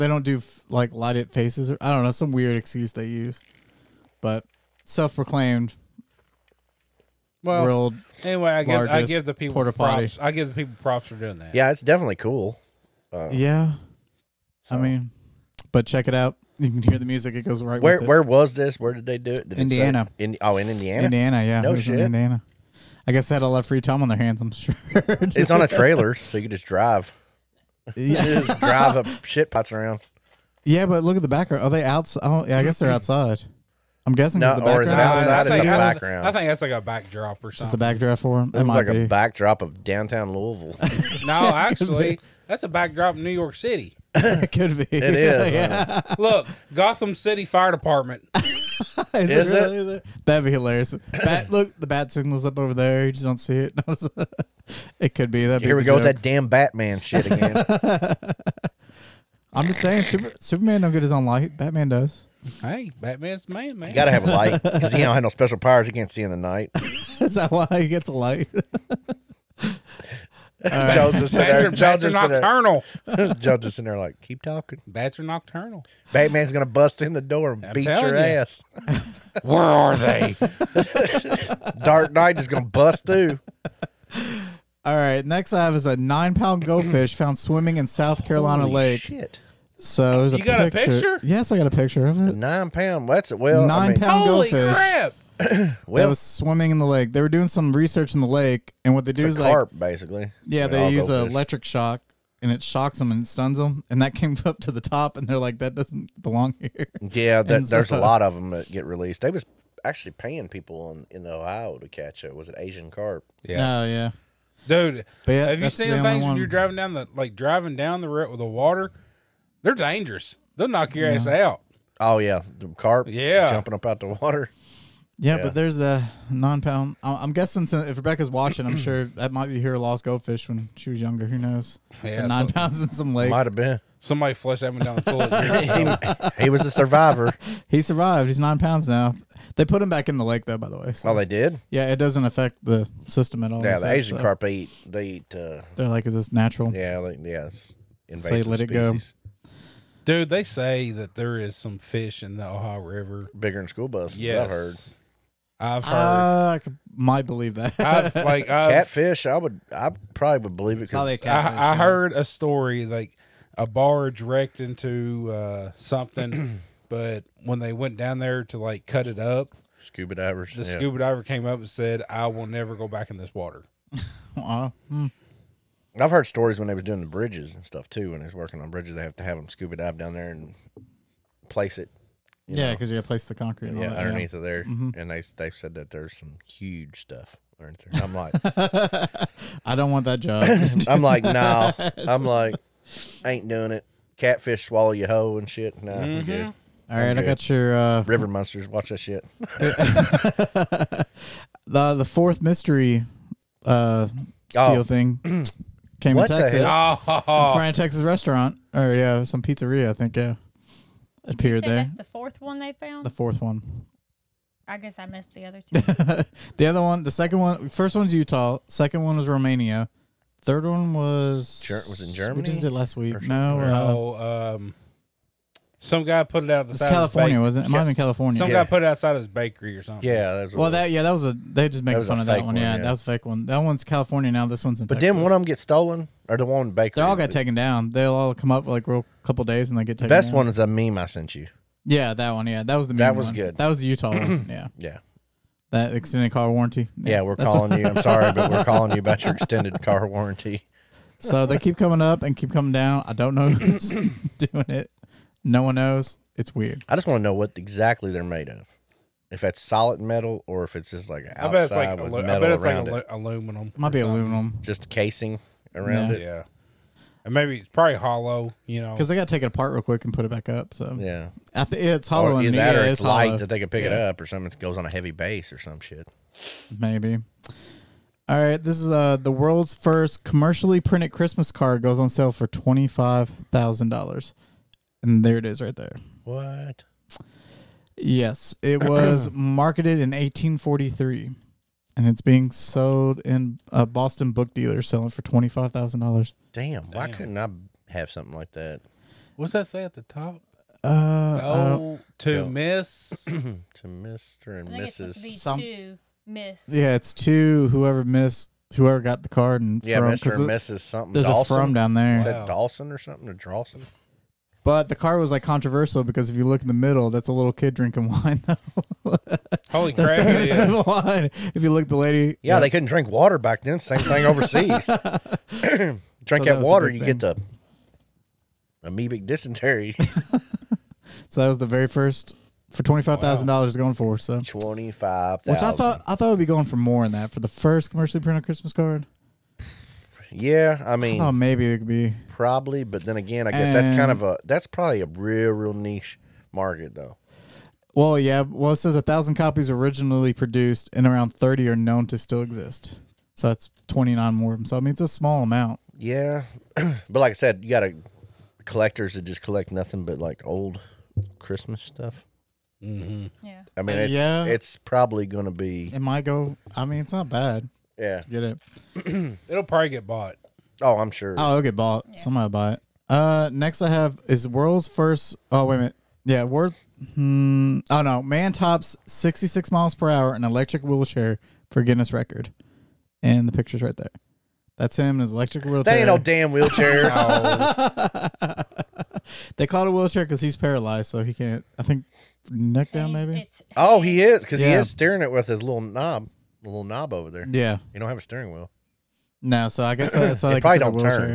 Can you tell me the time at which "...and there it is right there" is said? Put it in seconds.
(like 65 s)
285 s.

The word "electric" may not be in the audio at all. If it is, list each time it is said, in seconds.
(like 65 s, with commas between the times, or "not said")
101 s, 380 s, 385 s.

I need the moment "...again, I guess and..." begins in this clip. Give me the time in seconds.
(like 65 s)
343 s.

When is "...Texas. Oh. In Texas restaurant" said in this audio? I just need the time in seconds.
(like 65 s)
206 s.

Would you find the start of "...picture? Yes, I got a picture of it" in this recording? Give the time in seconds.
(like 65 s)
90 s.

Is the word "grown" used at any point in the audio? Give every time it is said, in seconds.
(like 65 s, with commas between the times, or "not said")
not said.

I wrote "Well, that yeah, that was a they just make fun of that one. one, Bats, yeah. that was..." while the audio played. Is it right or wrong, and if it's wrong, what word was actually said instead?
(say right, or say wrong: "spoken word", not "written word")
wrong: "Yeah", not "Bats".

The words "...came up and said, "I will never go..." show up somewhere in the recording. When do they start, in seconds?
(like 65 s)
171 s.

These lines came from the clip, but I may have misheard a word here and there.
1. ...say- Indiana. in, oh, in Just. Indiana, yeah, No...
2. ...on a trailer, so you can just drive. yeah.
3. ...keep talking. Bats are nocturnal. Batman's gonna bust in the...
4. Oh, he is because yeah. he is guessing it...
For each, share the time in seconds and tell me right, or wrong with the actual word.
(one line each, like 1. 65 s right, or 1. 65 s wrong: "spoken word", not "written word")
1. 19 s wrong: "Indiana", not "Just"
2. 25 s right
3. 74 s right
4. 393 s wrong: "steering", not "guessing".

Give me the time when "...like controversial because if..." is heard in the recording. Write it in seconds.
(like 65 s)
315 s.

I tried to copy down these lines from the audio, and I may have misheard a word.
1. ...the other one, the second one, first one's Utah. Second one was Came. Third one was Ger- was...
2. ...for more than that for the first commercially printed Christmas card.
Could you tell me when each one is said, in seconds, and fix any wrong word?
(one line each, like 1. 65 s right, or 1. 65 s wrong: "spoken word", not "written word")
1. 216 s wrong: "Romania", not "Came"
2. 336 s right.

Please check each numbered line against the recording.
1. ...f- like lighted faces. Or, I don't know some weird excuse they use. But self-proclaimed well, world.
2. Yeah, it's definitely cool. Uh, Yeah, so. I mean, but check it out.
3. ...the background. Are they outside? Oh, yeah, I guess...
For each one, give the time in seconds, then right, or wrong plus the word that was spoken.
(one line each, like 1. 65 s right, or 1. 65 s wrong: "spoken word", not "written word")
1. 0 s right
2. 11 s right
3. 31 s right.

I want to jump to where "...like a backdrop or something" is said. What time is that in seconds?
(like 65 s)
36 s.